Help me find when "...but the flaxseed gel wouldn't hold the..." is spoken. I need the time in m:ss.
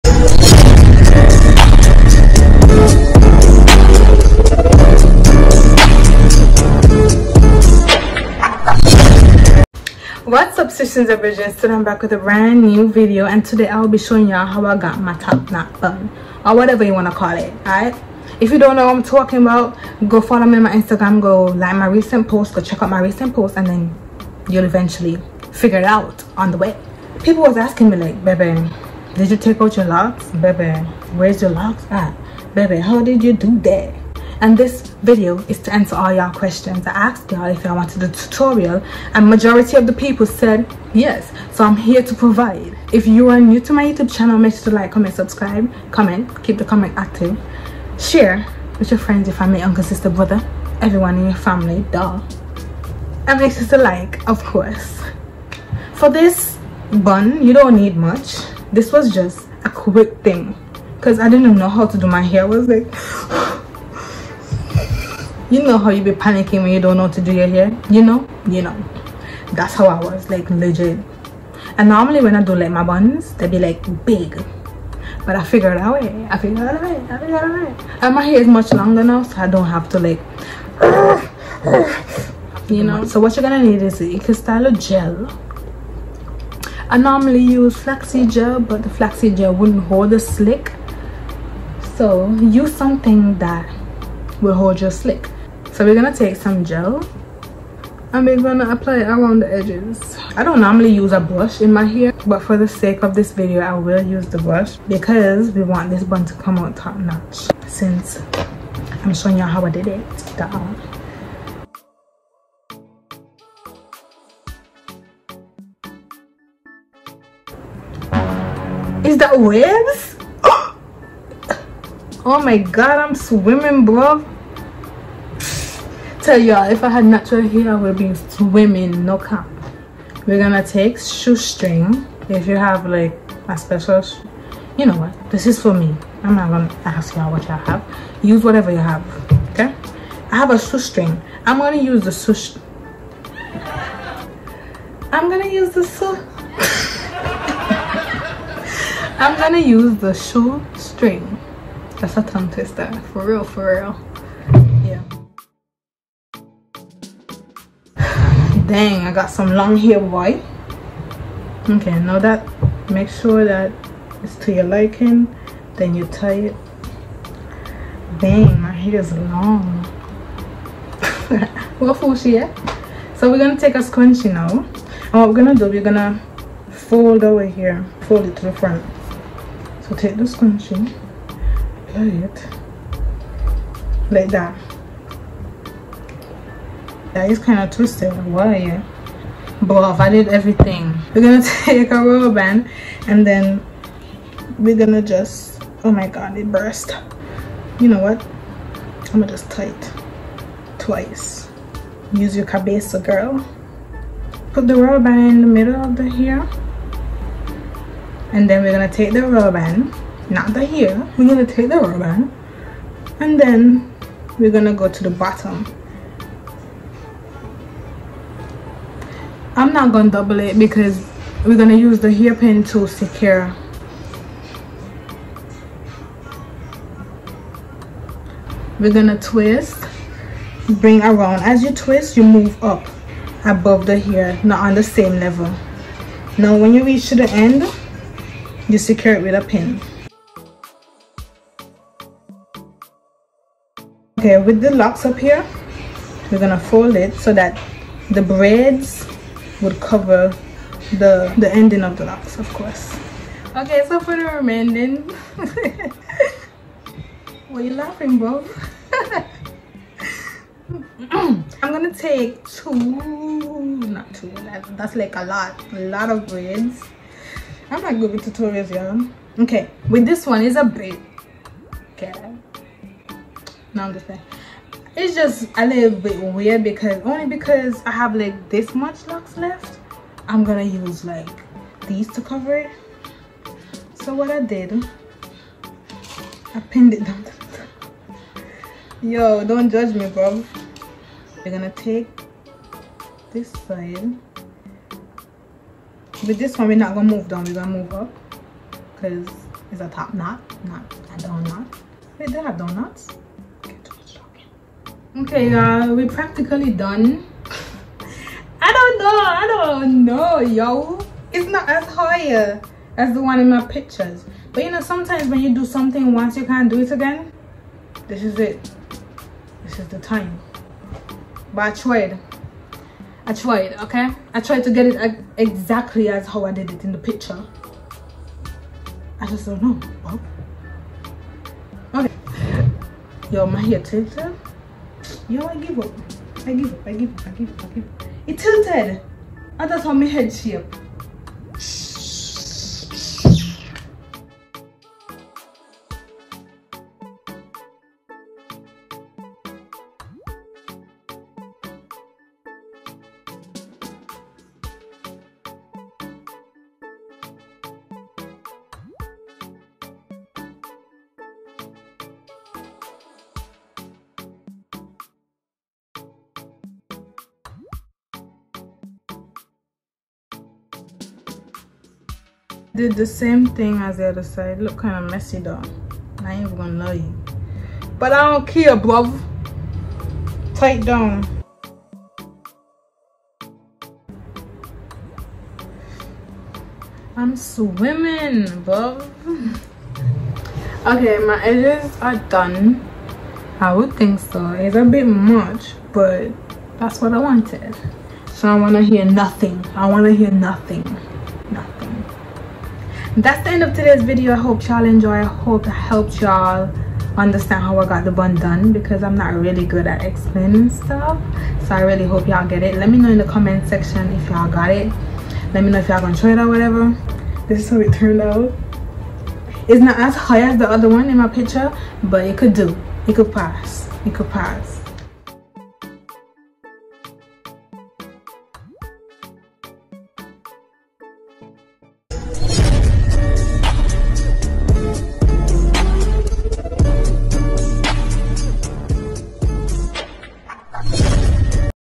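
1:28.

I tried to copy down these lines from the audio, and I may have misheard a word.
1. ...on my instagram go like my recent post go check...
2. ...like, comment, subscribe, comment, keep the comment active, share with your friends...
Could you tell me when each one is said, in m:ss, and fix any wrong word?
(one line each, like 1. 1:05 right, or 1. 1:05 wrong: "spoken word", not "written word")
1. 0:20 right
2. 0:44 right.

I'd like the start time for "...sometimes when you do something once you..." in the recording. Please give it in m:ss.
5:14.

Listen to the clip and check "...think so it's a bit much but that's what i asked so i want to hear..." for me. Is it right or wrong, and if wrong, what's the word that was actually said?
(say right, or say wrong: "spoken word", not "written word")
wrong: "wanted", not "asked".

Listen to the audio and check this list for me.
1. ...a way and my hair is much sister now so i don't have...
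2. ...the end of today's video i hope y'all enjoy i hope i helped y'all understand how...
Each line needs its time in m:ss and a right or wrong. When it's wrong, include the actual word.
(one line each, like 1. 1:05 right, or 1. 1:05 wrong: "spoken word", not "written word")
1. 1:17 wrong: "longer", not "sister"
2. 6:43 right.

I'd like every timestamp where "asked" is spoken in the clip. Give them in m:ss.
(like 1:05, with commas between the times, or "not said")
0:36.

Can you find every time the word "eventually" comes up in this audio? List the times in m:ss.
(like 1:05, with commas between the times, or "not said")
0:24.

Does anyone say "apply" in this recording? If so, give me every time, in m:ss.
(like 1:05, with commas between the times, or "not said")
1:38, 3:01.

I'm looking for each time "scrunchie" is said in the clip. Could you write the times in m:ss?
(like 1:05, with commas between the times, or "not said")
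2:53, 3:00.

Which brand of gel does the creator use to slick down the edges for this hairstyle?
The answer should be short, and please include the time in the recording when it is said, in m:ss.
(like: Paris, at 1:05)
Cristallo gel, at 1:24.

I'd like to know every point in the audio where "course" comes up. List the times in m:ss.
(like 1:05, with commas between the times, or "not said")
0:54, 4:12.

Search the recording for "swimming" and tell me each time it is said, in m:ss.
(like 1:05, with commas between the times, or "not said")
2:03, 2:08, 6:27.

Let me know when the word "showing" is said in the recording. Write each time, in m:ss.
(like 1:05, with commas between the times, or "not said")
0:13, 1:49.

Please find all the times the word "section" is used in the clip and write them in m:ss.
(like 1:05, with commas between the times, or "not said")
6:53.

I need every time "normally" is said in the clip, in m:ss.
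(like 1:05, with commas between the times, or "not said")
1:11, 1:26, 1:40.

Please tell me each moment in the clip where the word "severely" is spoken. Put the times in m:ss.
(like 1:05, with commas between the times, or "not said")
not said.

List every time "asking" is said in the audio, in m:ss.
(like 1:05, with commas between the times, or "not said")
0:27.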